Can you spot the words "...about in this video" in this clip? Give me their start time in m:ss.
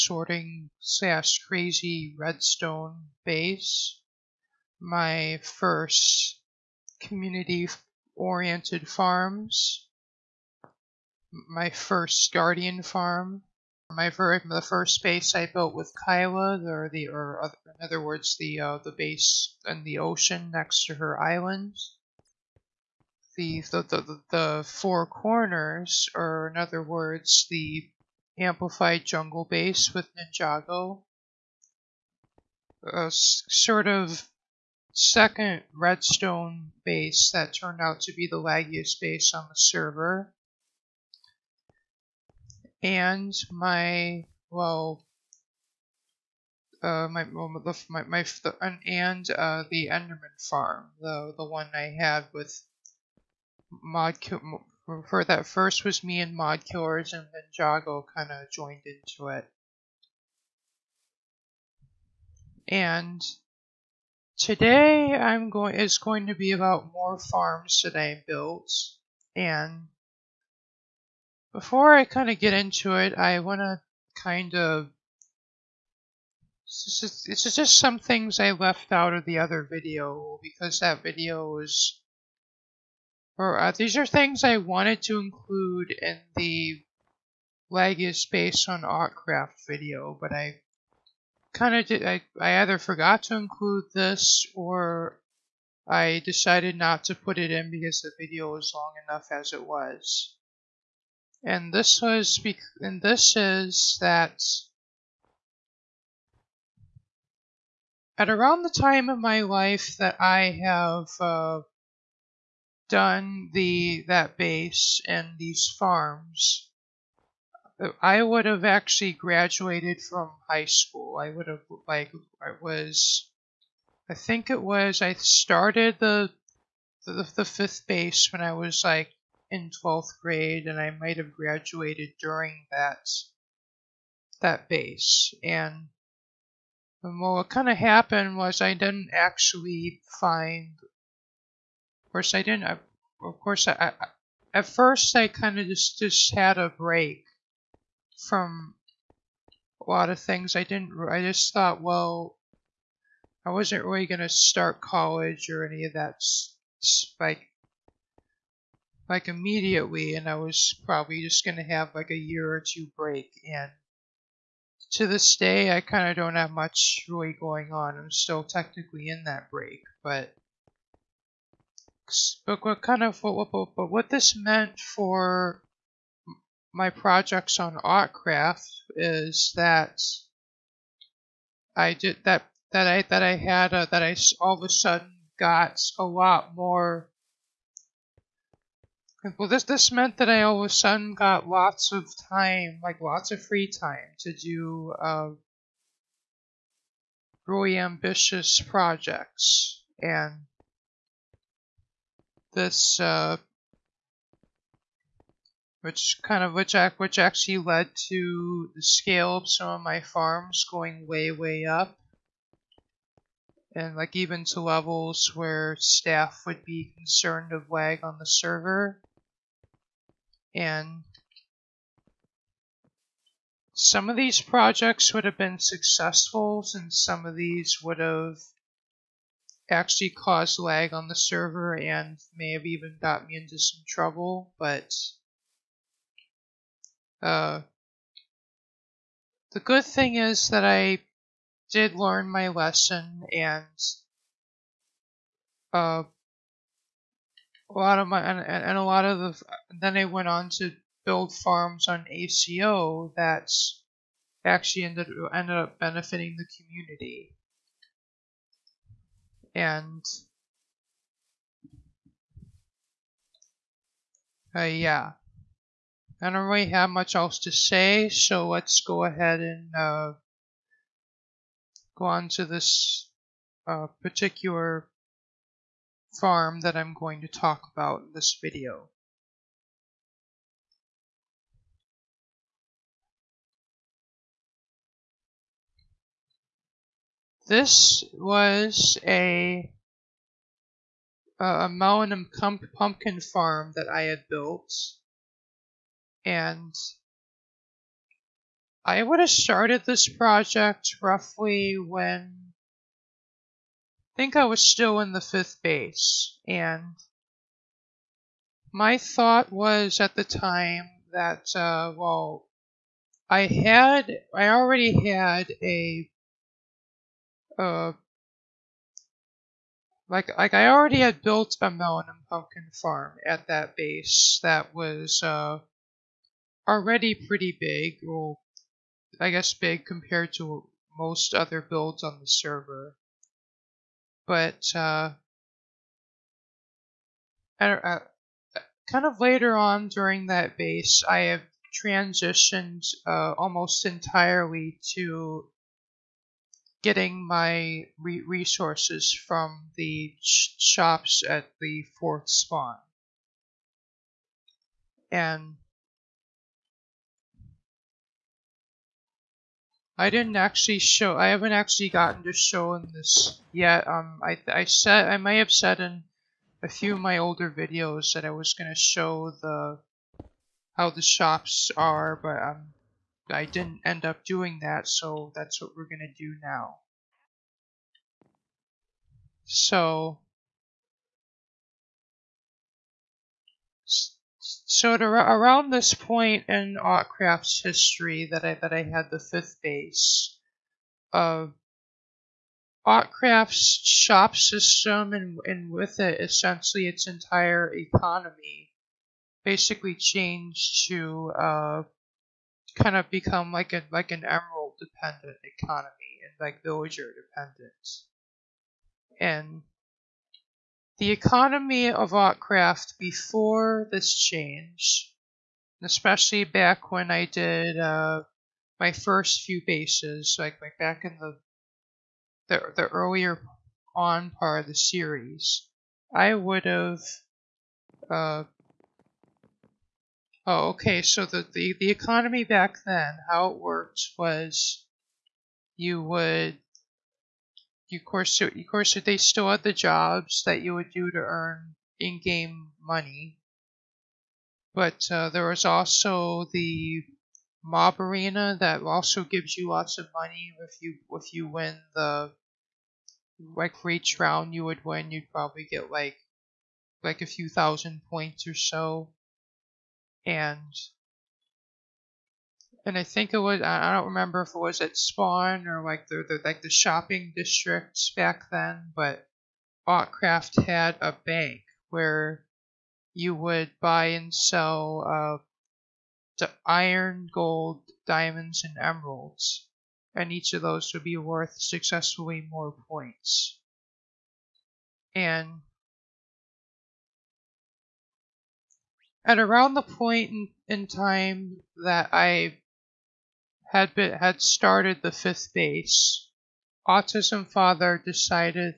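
4:37.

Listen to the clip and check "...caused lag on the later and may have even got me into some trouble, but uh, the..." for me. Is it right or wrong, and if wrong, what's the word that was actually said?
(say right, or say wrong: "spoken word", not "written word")
wrong: "server", not "later".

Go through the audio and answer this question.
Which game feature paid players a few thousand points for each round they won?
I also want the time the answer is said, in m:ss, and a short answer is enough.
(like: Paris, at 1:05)
mob arena, at 7:27.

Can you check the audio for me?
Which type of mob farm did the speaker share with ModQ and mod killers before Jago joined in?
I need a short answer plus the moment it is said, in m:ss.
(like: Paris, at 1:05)
Enderman farm, at 0:49.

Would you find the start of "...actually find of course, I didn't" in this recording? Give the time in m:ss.
2:19.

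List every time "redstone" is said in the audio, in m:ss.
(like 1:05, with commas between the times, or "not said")
0:02, 0:35.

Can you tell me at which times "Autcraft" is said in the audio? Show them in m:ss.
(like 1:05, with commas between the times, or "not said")
1:28, 2:57, 6:26, 6:32, 6:52, 7:49.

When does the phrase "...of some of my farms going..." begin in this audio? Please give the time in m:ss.
3:29.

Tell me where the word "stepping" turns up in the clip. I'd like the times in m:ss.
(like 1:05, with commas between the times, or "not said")
not said.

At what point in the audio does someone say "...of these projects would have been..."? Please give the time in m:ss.
3:44.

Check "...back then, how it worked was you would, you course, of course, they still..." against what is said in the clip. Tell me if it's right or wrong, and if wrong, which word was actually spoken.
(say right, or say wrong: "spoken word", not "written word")
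right.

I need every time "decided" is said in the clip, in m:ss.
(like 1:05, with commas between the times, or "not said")
1:36, 8:18.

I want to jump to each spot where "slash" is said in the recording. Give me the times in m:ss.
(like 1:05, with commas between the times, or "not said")
0:00.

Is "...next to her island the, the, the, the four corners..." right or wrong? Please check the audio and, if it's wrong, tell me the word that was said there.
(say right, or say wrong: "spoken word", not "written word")
right.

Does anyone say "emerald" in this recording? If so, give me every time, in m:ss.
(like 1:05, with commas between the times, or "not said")
6:44, 7:58.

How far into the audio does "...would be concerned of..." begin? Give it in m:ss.
3:36.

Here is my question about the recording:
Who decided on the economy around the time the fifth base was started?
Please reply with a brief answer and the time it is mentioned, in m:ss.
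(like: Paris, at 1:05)
AutismFather, at 8:16.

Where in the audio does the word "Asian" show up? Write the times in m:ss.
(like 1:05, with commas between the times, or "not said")
not said.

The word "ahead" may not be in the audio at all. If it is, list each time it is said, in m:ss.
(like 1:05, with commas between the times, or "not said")
4:29.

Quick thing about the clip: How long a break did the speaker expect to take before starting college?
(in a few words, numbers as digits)
a year or two.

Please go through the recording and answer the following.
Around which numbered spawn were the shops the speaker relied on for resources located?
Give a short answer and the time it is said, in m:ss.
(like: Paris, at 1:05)
fourth spawn, at 5:51.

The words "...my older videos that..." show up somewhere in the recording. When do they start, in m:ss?
6:07.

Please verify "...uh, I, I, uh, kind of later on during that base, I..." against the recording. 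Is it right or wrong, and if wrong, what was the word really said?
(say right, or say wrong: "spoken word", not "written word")
right.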